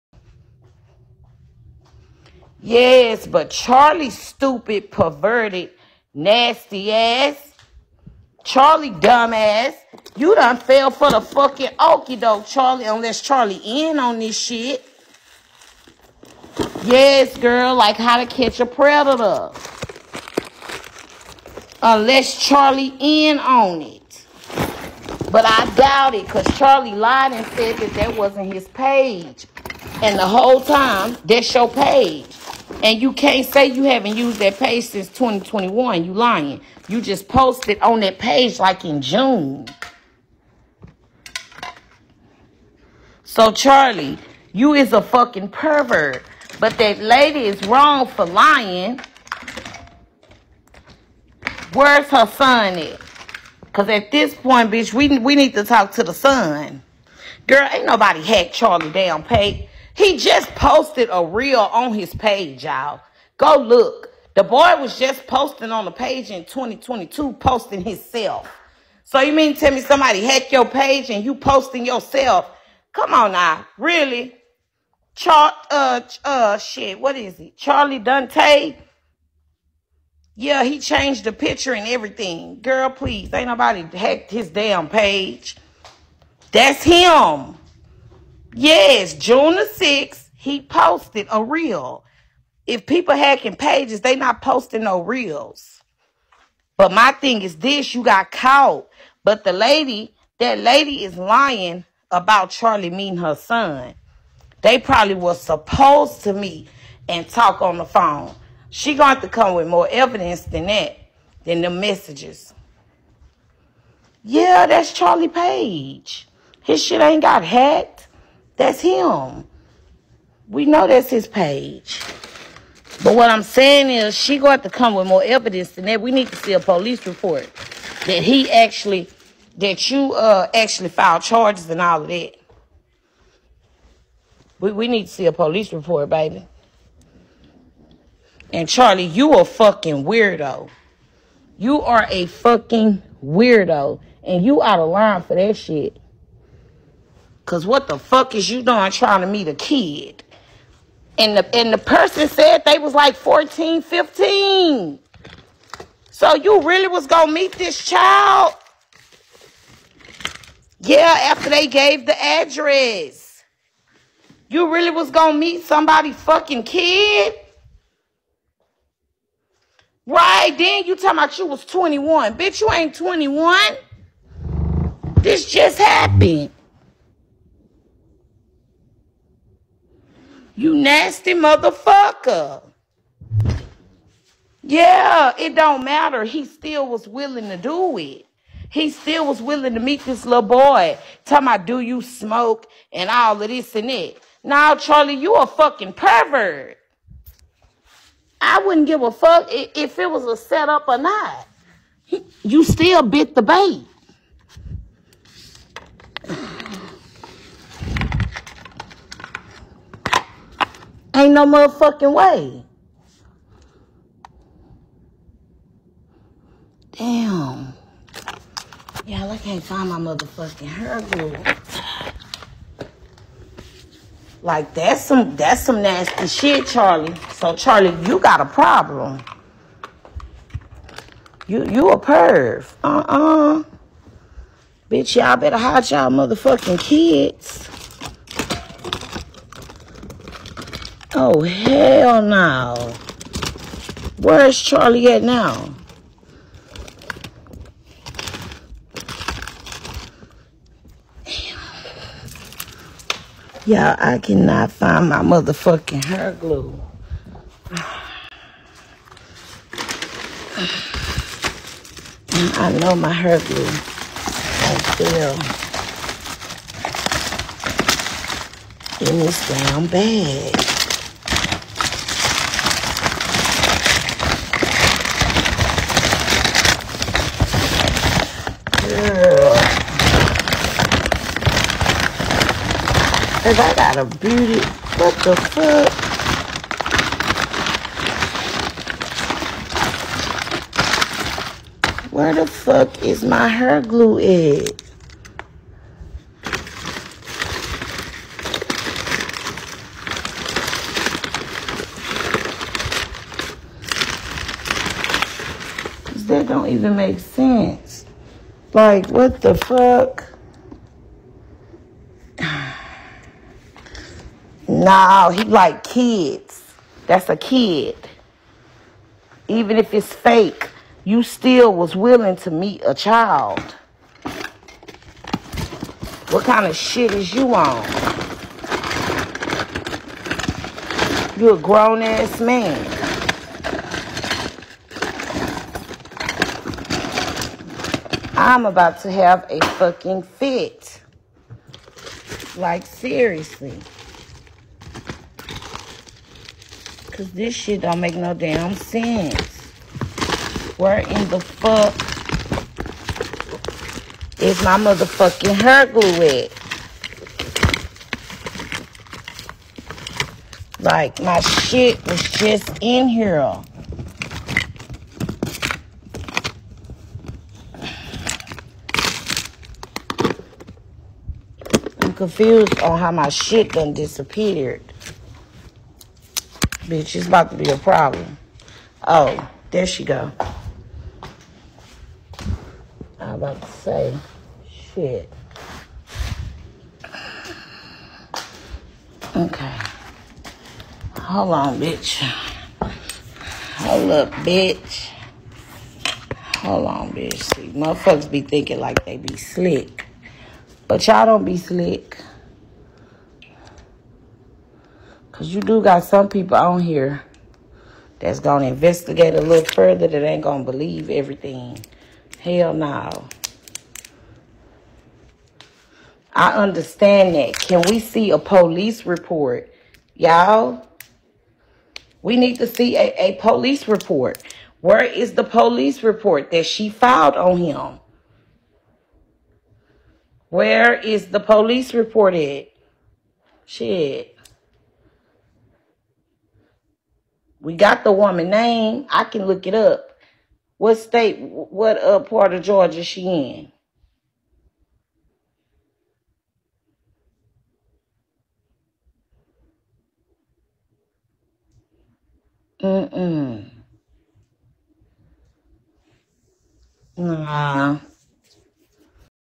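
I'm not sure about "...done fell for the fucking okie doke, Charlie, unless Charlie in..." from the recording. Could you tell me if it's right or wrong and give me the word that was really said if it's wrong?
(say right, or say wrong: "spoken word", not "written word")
right.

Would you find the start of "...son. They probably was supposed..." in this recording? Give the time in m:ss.
1:43.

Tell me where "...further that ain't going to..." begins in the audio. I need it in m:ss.
6:49.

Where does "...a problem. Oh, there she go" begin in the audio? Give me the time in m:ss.
6:17.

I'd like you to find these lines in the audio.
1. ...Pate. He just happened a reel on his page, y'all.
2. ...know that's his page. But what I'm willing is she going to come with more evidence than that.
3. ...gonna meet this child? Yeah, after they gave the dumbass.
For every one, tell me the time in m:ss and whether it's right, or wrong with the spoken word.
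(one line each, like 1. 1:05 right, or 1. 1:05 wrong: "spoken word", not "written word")
1. 0:59 wrong: "posted", not "happened"
2. 2:00 wrong: "saying", not "willing"
3. 2:37 wrong: "address", not "dumbass".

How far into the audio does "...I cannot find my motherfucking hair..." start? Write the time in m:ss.
4:13.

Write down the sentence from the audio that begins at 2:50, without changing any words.
Right, then you talking about you was 21.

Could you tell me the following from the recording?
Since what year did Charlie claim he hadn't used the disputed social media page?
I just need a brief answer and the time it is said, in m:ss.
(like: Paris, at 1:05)
2021, at 0:35.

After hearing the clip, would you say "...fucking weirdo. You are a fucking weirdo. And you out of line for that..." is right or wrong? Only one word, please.
right.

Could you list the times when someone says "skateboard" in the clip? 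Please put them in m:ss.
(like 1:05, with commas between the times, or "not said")
not said.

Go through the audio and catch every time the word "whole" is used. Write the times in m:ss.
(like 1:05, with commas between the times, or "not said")
0:30.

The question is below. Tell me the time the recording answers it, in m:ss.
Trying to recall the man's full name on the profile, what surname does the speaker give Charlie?
1:17.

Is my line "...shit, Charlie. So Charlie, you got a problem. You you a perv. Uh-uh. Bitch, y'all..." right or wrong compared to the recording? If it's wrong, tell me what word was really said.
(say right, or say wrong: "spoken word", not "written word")
right.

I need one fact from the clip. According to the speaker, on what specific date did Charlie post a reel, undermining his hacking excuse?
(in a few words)
June 6th.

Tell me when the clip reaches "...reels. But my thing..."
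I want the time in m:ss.
1:35.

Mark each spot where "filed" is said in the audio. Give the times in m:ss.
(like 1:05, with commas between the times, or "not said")
2:10, 7:06.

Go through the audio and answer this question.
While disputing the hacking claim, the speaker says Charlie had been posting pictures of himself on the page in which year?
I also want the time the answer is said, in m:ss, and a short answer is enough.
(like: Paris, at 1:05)
2022, at 1:06.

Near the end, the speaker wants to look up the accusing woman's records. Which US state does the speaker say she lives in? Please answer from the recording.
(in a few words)
Georgia.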